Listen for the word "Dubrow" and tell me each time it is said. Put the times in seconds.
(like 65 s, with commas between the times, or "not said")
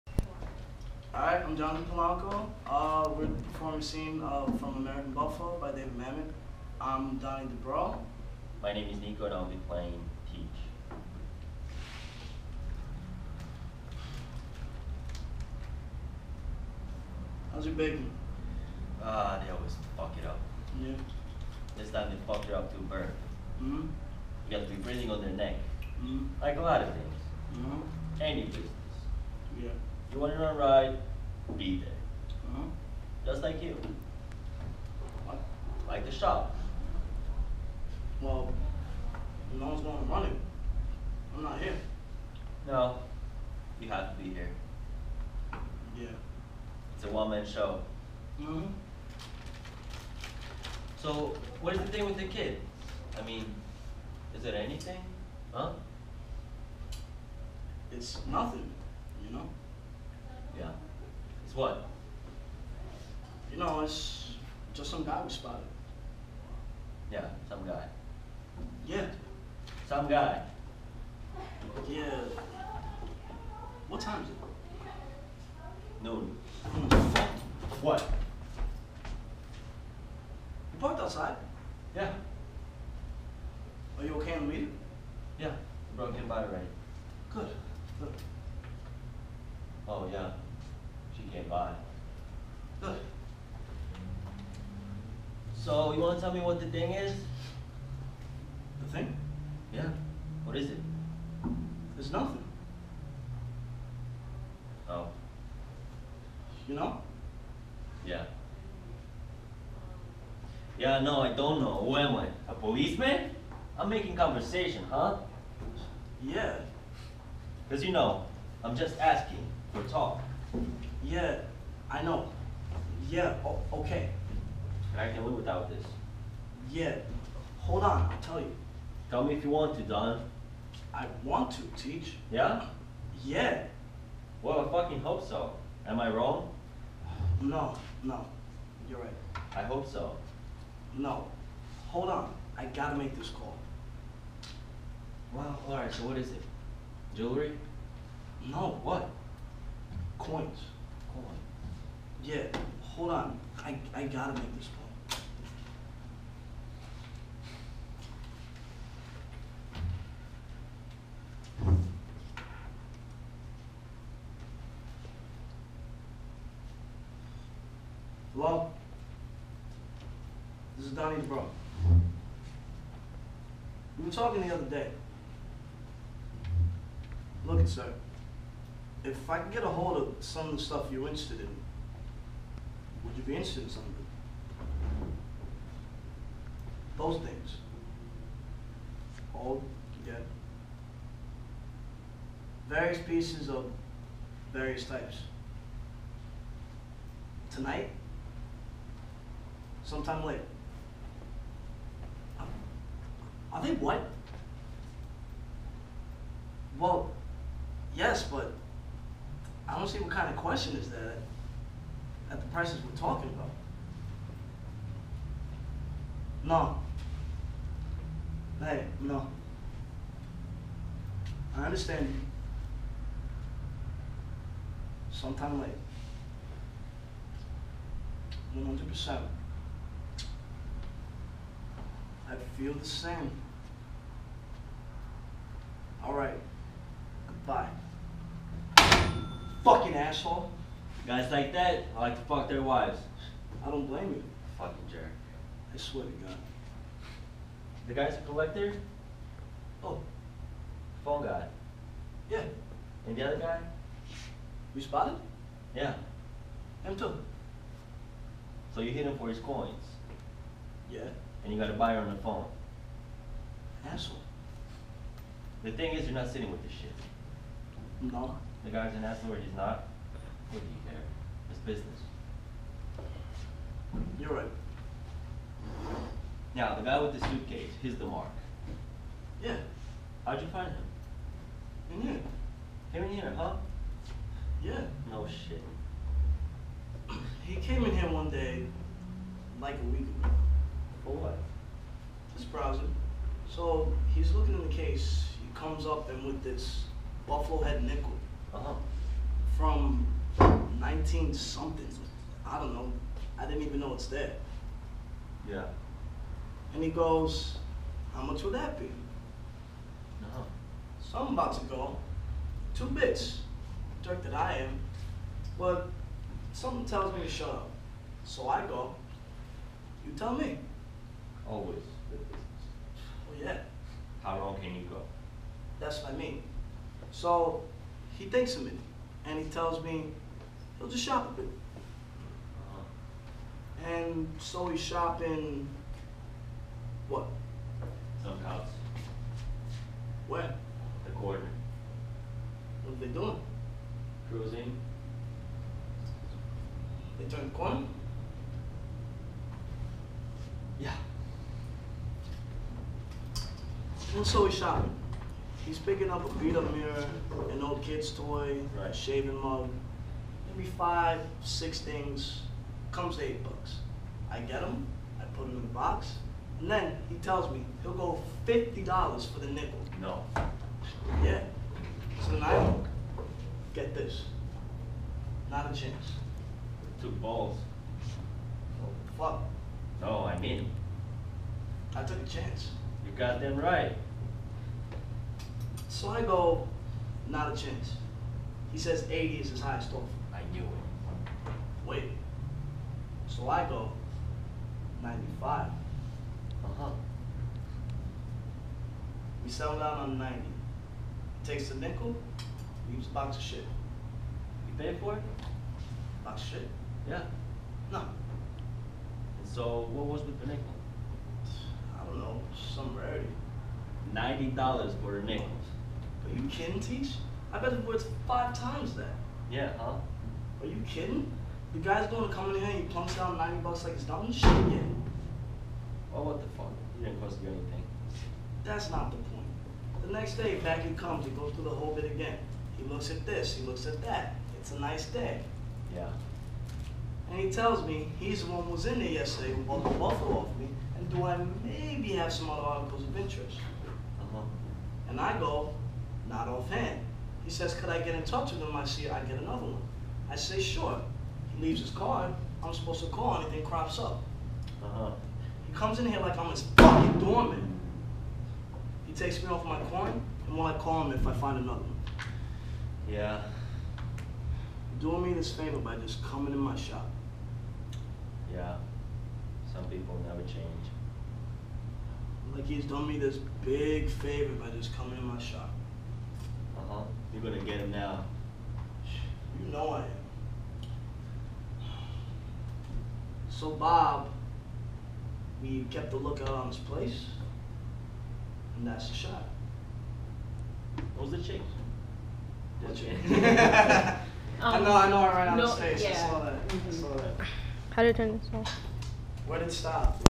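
7 s, 171 s.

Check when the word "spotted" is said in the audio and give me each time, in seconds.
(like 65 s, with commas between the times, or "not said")
65 s, 254 s.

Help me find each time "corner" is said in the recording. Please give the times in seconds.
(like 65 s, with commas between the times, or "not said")
341 s, 347 s.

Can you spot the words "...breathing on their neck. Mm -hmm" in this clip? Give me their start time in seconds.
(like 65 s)
24 s.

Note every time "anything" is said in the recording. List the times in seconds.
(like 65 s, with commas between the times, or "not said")
54 s, 427 s, 453 s.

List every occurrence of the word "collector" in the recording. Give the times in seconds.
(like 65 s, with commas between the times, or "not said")
248 s.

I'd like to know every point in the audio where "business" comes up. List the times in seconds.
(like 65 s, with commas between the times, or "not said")
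28 s, 271 s.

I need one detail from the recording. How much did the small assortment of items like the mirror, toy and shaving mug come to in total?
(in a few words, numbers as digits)
$8.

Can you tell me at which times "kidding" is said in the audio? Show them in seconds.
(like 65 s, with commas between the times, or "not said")
416 s, 420 s.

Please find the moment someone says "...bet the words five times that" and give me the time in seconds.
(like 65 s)
417 s.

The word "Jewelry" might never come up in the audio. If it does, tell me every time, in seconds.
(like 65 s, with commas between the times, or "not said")
147 s.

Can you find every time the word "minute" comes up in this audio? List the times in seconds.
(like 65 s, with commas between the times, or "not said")
328 s.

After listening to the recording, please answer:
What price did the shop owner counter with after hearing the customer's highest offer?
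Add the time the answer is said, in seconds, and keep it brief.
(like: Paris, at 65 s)
$95, at 395 s.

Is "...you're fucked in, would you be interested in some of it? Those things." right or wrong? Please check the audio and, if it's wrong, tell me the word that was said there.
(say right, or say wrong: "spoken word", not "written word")
wrong: "interested", not "fucked".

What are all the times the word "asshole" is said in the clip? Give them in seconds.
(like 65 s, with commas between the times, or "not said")
239 s, 263 s.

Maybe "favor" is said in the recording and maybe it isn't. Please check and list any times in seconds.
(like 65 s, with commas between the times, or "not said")
465 s, 474 s.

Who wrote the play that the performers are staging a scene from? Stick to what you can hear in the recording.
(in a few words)
David Mamet.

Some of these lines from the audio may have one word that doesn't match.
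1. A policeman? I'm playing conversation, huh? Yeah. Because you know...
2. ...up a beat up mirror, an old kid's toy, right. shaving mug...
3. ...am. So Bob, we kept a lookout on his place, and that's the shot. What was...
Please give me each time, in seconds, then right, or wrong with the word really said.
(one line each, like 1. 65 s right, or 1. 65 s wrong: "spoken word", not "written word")
1. 112 s wrong: "making", not "playing"
2. 356 s right
3. 479 s right.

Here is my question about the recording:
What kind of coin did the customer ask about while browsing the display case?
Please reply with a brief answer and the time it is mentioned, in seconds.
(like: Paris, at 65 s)
Buffalo head nickel, at 297 s.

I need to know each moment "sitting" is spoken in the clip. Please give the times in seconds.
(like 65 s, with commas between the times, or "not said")
266 s.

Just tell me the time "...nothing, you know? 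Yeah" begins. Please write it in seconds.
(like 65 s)
58 s.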